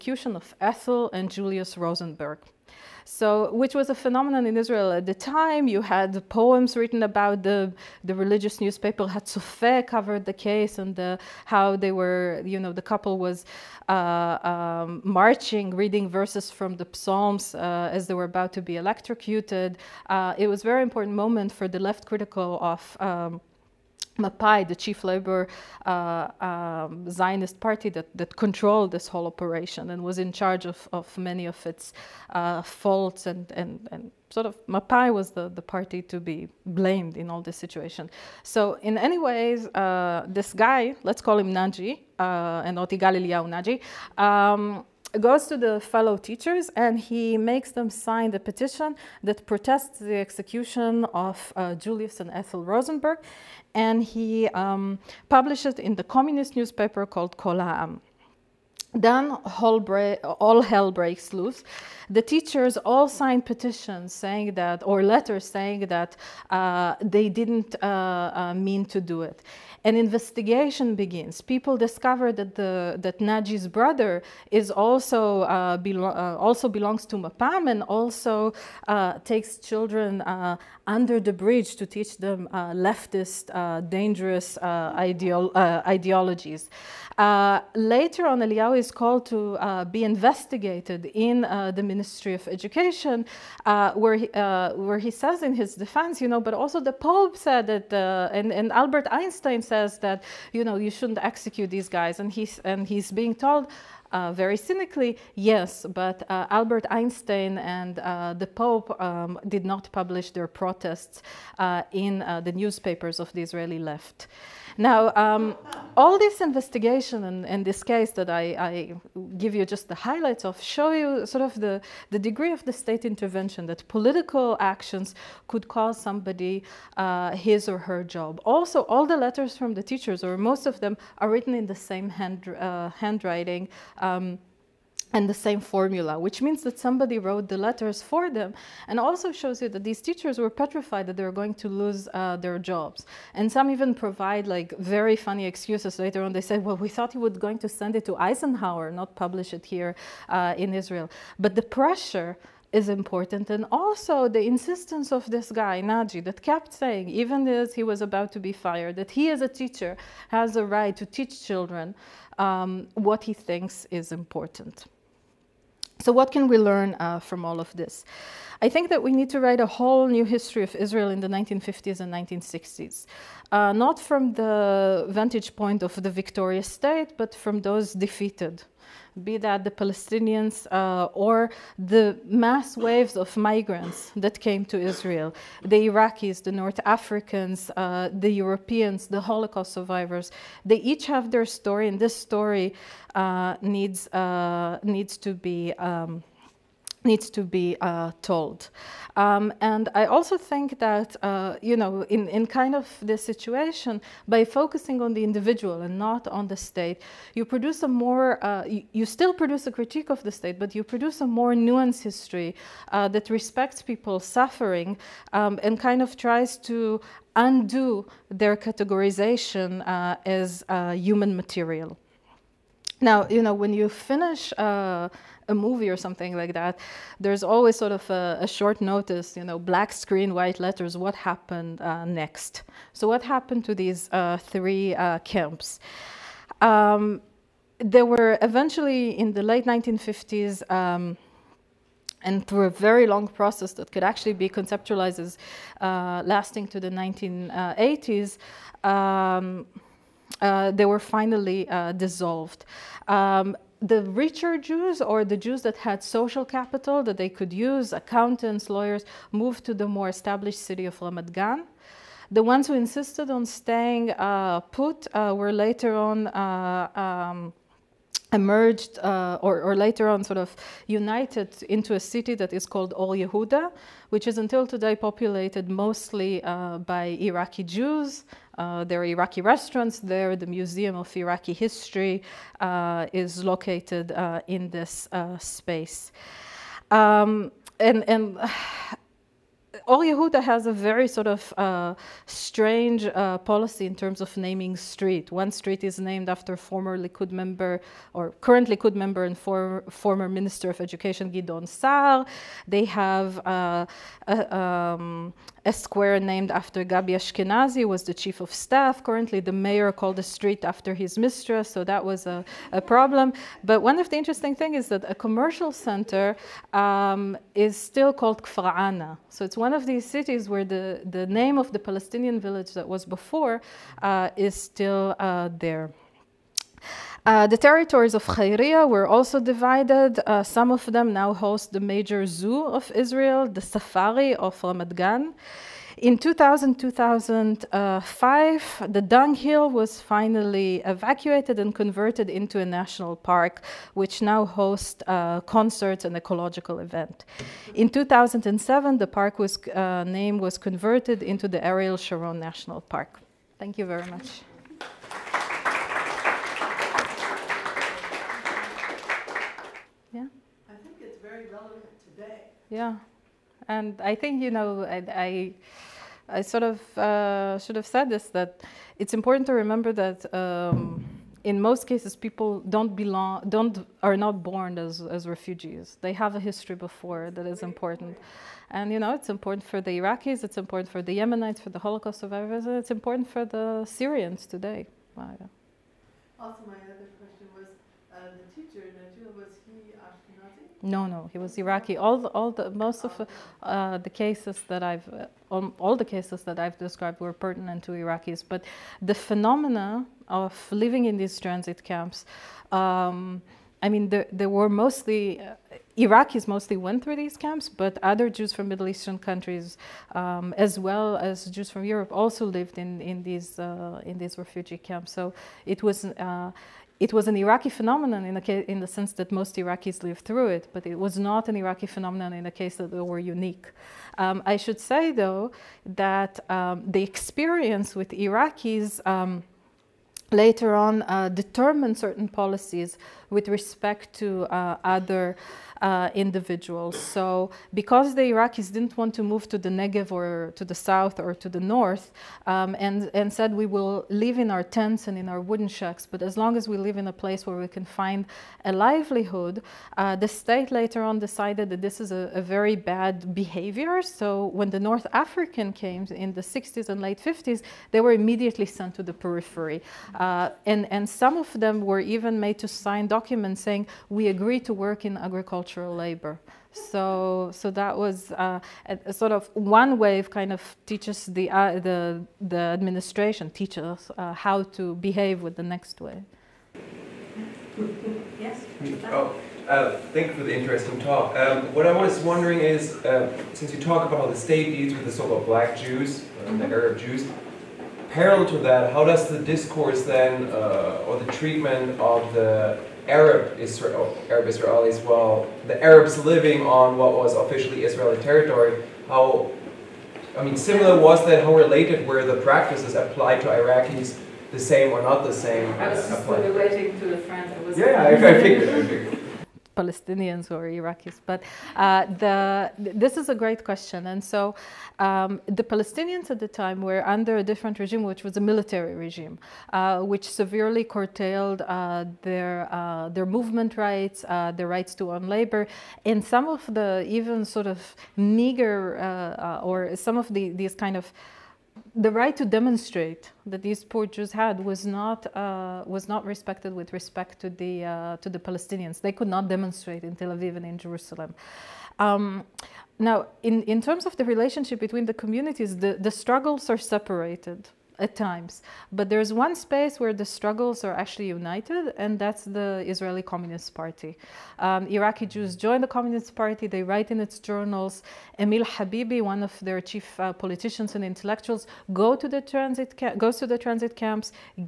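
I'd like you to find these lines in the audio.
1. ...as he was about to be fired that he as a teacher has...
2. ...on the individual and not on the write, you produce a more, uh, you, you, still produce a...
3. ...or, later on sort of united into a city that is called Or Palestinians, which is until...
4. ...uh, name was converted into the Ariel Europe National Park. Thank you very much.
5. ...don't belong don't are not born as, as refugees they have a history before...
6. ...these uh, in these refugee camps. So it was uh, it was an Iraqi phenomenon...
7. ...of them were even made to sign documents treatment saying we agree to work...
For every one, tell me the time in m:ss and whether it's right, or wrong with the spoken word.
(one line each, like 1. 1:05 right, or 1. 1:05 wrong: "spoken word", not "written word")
1. 2:37 right
2. 3:25 wrong: "state", not "write"
3. 4:29 wrong: "Yehuda", not "Palestinians"
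4. 5:49 wrong: "Sharon", not "Europe"
5. 6:12 right
6. 6:53 right
7. 7:41 wrong: "document", not "treatment".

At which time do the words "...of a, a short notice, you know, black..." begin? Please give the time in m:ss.
3:47.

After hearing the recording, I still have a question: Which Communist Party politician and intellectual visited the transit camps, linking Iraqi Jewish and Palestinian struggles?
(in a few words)
Emil Habibi.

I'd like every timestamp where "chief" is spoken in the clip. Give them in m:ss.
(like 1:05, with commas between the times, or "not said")
0:24, 5:08, 9:19.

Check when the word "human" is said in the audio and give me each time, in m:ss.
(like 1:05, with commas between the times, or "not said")
3:40.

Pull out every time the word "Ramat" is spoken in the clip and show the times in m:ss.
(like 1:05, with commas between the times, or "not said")
4:21, 5:34.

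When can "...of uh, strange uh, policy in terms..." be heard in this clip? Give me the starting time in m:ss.
4:51.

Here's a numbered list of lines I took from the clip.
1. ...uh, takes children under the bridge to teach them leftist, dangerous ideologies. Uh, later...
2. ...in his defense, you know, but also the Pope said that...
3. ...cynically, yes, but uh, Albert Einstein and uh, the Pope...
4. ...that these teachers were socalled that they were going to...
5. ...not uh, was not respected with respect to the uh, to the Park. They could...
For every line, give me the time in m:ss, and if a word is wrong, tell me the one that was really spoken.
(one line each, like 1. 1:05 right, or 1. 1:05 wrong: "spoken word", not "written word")
1. 1:18 right
2. 1:35 right
3. 1:44 right
4. 2:19 wrong: "petrified", not "socalled"
5. 8:54 wrong: "Palestinians", not "Park".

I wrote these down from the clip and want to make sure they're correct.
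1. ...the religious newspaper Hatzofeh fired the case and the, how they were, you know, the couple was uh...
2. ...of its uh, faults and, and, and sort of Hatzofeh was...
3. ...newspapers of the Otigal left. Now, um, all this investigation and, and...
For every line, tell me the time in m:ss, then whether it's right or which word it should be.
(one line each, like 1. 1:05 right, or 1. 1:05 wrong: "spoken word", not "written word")
1. 0:08 wrong: "covered", not "fired"
2. 0:31 wrong: "Mapai", not "Hatzofeh"
3. 1:52 wrong: "Israeli", not "Otigal".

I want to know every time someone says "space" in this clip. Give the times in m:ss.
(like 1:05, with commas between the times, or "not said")
4:45, 9:09.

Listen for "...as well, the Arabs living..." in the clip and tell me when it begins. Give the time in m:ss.
8:14.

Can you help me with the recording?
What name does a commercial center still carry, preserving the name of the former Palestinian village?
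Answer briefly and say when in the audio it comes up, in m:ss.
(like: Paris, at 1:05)
Kfarana, at 5:18.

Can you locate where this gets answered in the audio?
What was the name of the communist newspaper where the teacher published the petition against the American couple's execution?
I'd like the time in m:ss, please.
0:57.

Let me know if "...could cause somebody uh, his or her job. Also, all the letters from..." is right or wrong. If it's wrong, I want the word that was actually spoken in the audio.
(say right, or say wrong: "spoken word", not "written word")
right.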